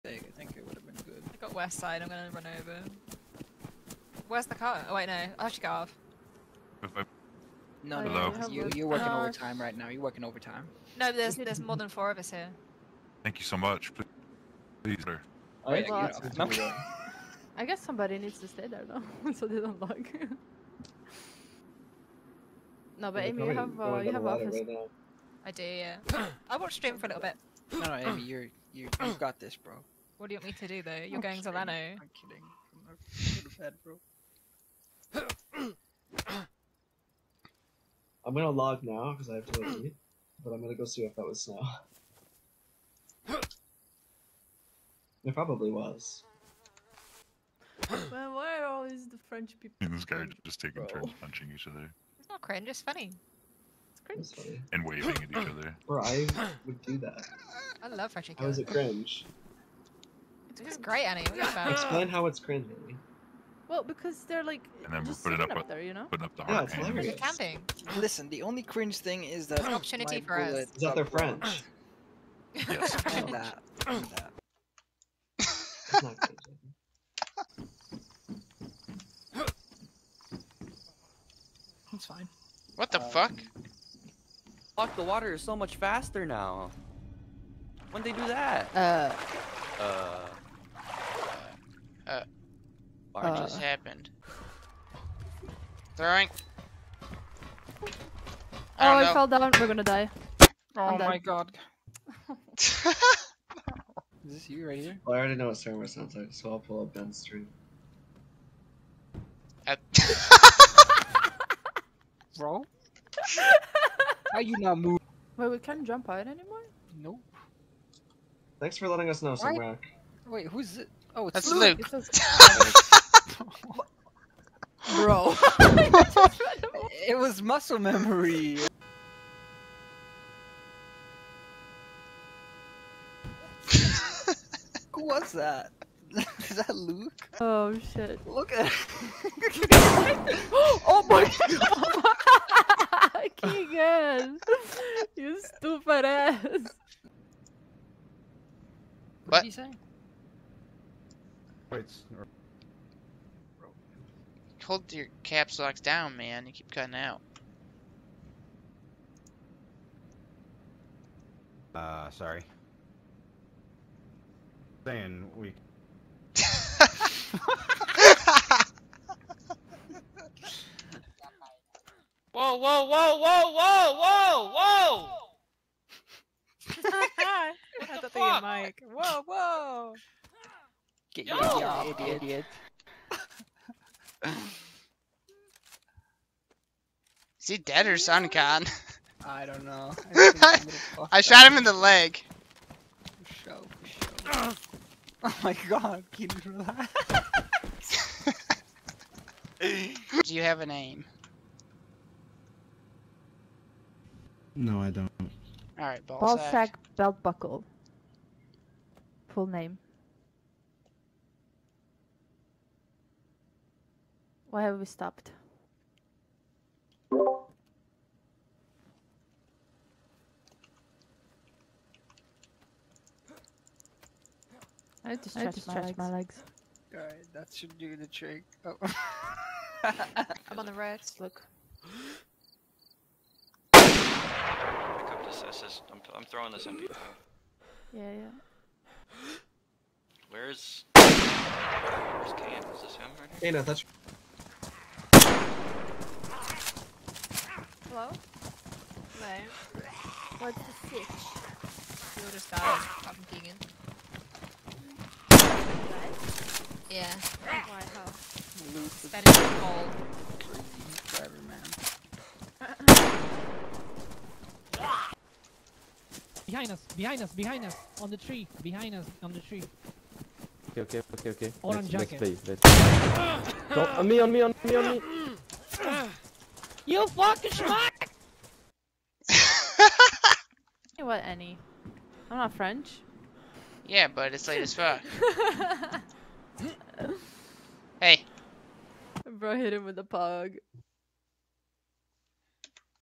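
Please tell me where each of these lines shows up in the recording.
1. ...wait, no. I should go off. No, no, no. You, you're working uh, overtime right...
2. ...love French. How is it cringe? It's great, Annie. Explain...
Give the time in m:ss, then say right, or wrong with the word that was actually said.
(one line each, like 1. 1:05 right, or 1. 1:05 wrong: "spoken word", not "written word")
1. 0:04 right
2. 0:57 right.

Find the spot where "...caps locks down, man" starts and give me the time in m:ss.
2:35.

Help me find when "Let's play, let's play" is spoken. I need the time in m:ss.
4:32.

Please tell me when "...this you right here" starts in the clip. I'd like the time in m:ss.
1:44.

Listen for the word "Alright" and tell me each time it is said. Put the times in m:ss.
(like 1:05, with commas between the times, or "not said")
3:25, 3:46.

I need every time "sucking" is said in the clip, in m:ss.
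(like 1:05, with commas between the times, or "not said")
not said.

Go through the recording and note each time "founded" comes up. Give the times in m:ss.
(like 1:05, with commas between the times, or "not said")
not said.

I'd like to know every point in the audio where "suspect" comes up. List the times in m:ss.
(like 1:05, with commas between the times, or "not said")
not said.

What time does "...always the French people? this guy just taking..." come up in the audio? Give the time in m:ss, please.
0:48.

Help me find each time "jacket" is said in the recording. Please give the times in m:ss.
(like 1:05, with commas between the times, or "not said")
4:32.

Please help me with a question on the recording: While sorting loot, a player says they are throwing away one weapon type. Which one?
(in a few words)
MP.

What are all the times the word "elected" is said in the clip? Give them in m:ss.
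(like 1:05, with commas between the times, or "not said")
not said.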